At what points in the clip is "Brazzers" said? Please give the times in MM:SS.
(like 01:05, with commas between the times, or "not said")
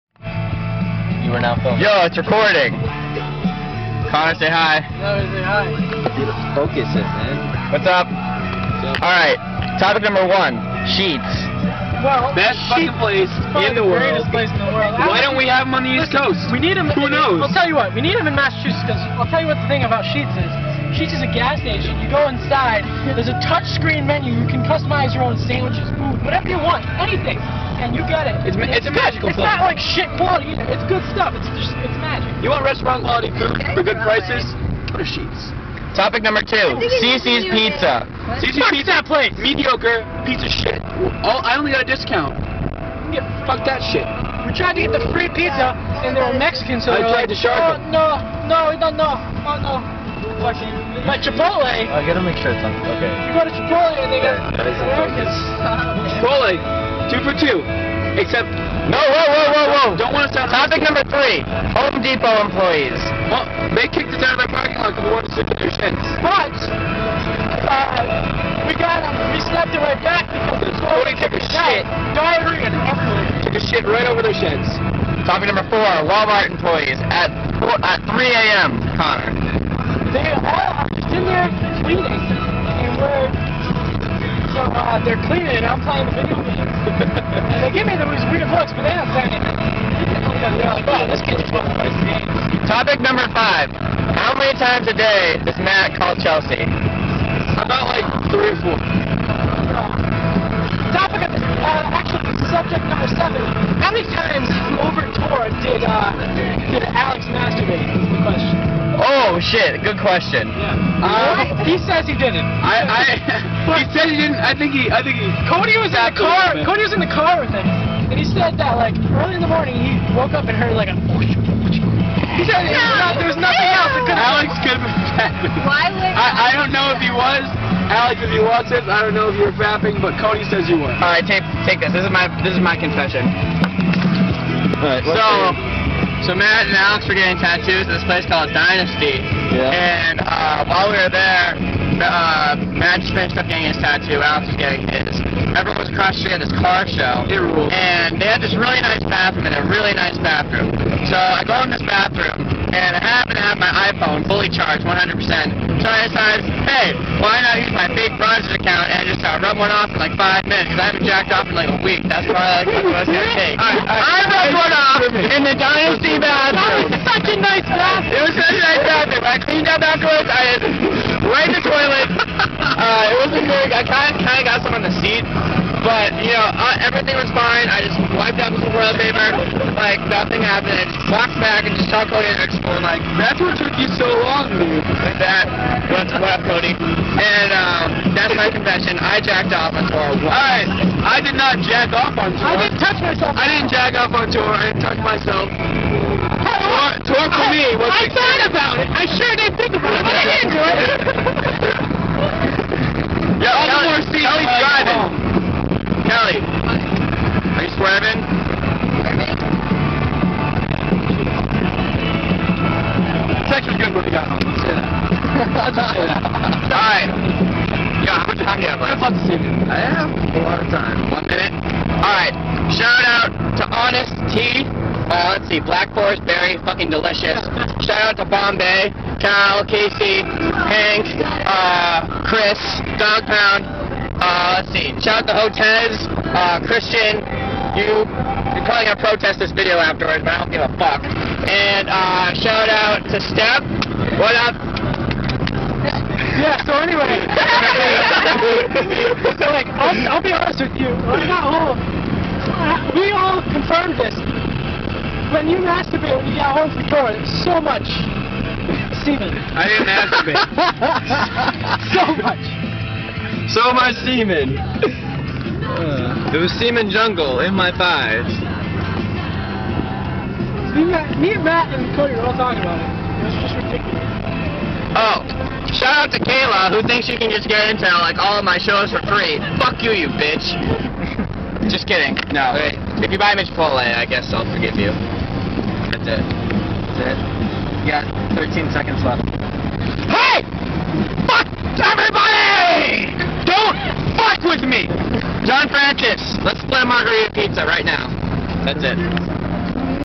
02:38.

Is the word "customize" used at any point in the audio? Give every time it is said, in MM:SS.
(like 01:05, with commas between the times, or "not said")
00:24.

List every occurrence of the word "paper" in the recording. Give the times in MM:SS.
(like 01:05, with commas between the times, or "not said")
02:59.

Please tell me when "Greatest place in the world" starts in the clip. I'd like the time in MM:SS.
00:14.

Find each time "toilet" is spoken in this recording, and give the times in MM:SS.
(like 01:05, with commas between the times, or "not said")
02:51, 02:58.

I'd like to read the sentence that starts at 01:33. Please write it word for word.
How many times a day does Matt call Chelsea?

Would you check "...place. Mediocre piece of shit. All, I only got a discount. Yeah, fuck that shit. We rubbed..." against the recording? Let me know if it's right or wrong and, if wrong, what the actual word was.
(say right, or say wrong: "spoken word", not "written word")
wrong: "tried", not "rubbed".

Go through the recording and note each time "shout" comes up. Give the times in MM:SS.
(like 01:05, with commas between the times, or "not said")
03:42, 03:47, 03:55, 04:02, 04:35.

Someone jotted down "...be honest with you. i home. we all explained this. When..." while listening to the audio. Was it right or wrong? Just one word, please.
wrong.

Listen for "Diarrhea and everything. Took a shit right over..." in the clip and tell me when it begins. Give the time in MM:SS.
01:12.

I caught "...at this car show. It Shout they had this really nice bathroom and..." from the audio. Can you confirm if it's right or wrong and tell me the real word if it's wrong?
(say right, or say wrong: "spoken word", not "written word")
wrong: "And", not "Shout".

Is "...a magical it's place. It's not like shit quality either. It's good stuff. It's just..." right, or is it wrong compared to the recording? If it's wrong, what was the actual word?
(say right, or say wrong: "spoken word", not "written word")
right.